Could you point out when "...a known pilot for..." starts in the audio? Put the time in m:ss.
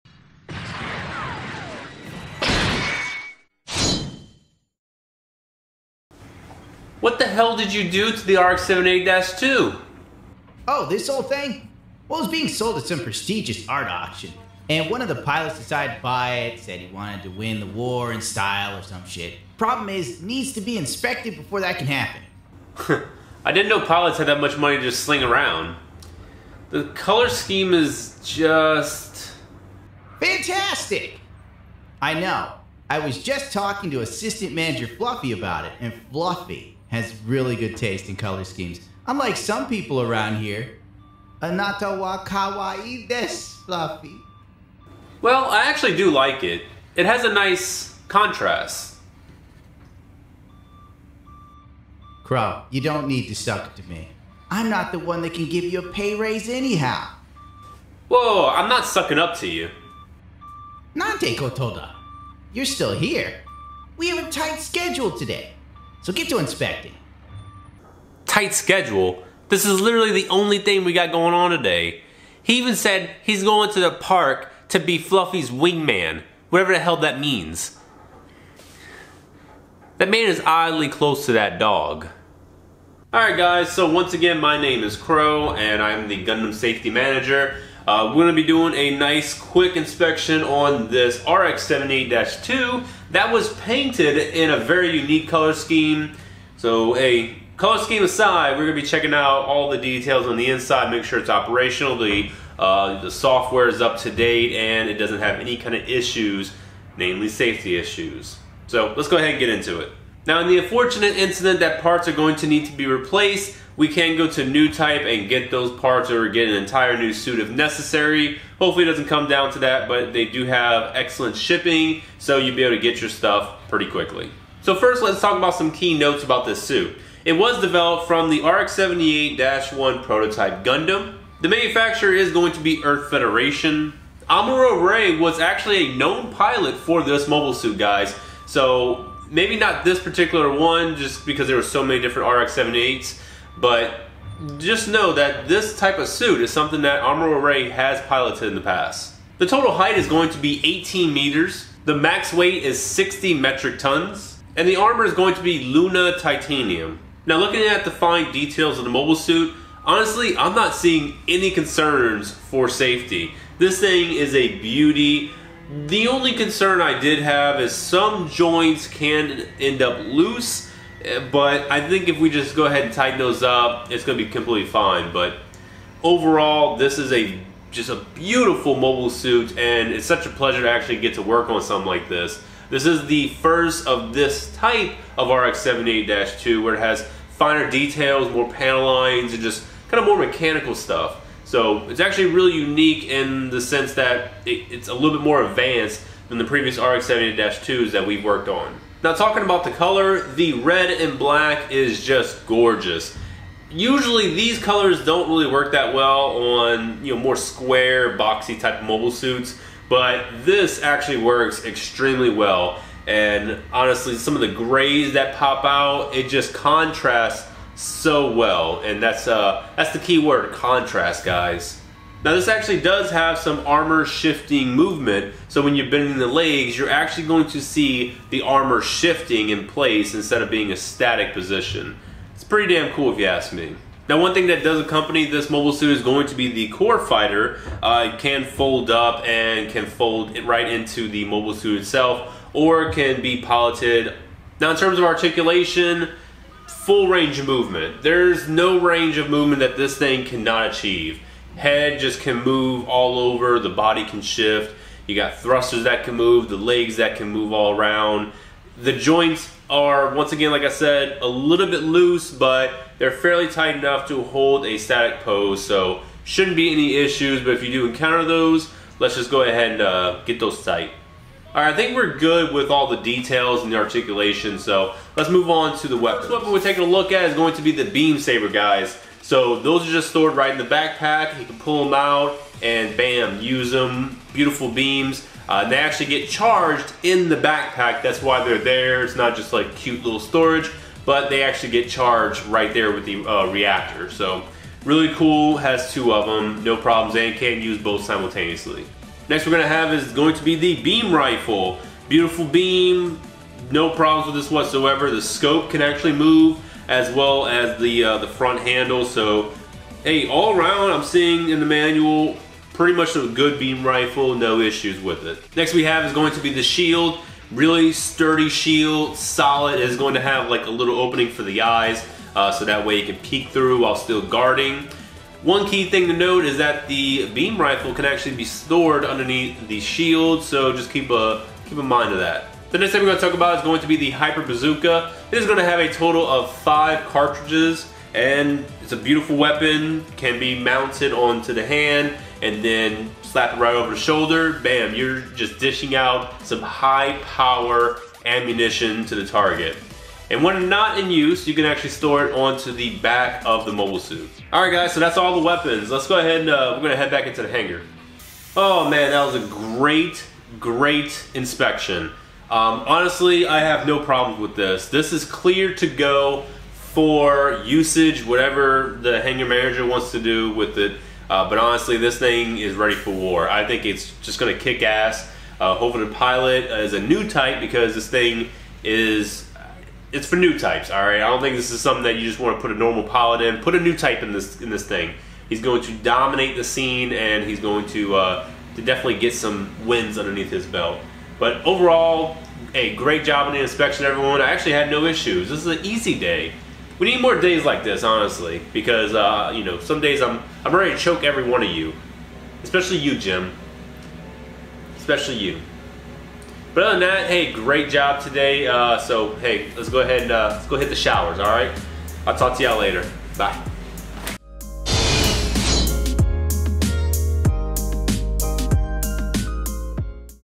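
2:15.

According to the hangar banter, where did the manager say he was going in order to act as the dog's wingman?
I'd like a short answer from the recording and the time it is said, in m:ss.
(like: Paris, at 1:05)
the park, at 1:13.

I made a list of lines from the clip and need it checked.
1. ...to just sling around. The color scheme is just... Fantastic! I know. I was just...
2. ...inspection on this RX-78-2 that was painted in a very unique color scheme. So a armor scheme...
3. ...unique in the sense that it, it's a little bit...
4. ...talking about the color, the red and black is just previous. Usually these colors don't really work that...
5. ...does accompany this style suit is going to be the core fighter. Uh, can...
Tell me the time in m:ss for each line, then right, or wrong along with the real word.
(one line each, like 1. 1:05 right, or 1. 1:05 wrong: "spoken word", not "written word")
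1. 0:24 right
2. 1:29 wrong: "color", not "armor"
3. 3:12 right
4. 3:19 wrong: "gorgeous", not "previous"
5. 3:54 wrong: "mobile", not "style".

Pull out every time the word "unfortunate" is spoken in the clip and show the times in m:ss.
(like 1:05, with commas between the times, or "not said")
1:50.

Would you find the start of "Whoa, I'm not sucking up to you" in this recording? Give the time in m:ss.
0:58.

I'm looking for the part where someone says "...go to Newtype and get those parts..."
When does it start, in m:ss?
1:54.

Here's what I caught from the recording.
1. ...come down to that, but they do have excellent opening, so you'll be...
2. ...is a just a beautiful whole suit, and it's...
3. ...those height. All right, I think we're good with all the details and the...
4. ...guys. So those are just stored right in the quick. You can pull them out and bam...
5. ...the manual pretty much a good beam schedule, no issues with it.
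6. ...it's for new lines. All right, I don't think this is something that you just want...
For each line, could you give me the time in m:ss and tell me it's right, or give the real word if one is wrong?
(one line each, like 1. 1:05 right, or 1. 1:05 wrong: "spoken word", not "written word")
1. 1:59 wrong: "shipping", not "opening"
2. 2:56 wrong: "mobile", not "whole"
3. 4:30 wrong: "tight", not "height"
4. 4:38 wrong: "backpack", not "quick"
5. 5:11 wrong: "rifle", not "schedule"
6. 6:20 wrong: "types", not "lines".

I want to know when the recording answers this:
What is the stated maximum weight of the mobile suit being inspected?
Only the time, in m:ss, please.
2:32.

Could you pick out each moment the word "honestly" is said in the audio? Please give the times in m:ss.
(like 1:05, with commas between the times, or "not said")
2:39, 3:33, 6:02, 6:11, 6:38.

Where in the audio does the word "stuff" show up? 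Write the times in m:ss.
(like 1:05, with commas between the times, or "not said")
2:03, 3:10.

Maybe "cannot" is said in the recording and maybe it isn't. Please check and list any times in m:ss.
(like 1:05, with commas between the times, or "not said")
4:10.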